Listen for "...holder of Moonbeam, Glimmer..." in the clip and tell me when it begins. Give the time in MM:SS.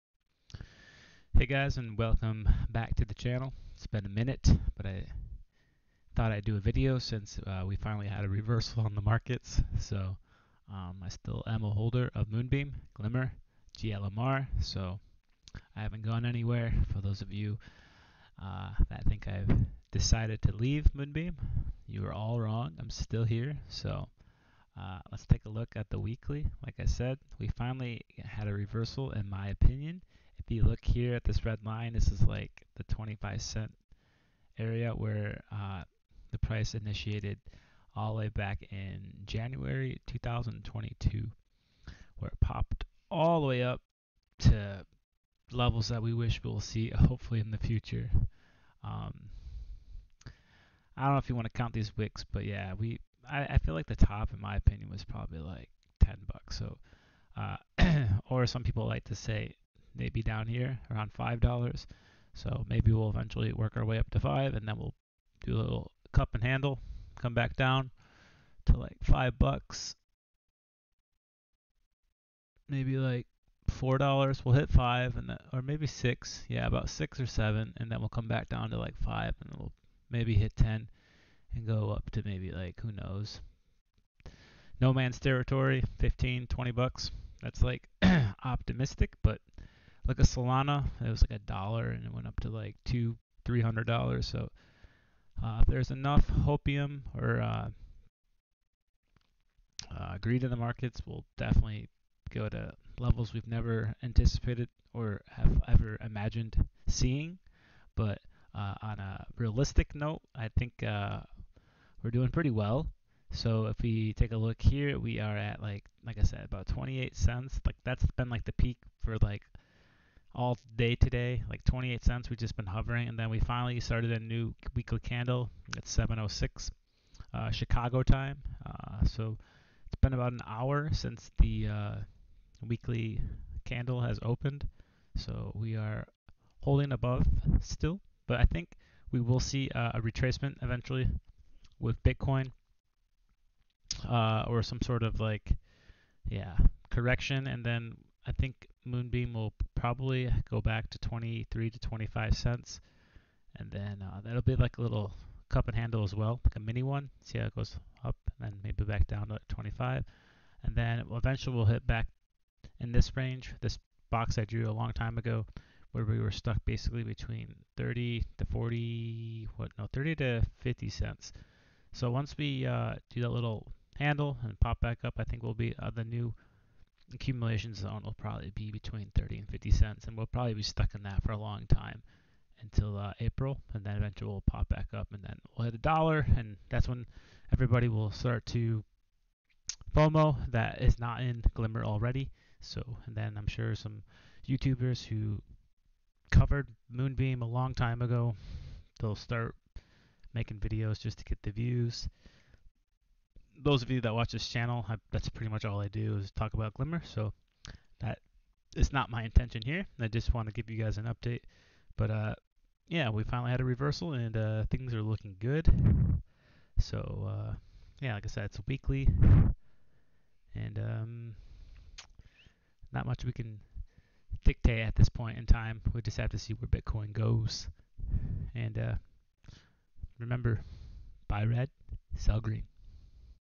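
00:11.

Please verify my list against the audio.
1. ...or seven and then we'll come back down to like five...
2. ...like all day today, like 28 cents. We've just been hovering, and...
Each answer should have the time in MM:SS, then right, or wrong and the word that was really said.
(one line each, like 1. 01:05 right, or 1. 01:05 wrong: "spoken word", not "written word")
1. 01:17 right
2. 01:59 right.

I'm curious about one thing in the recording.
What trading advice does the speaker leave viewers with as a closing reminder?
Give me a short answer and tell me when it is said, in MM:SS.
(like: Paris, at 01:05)
buy red, sell green, at 03:51.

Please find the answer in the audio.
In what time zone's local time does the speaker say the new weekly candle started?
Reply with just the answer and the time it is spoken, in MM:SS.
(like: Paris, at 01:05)
Chicago time, at 02:07.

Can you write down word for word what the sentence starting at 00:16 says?
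For those of you uh, that think I've decided to leave Moonbeam, you are all wrong.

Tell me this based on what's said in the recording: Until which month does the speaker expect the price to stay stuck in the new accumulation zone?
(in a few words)
April.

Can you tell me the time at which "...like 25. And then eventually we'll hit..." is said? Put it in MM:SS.
02:39.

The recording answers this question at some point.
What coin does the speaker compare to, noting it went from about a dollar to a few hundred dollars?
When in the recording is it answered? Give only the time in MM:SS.
01:30.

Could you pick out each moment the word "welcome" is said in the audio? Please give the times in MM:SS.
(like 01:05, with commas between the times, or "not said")
00:01.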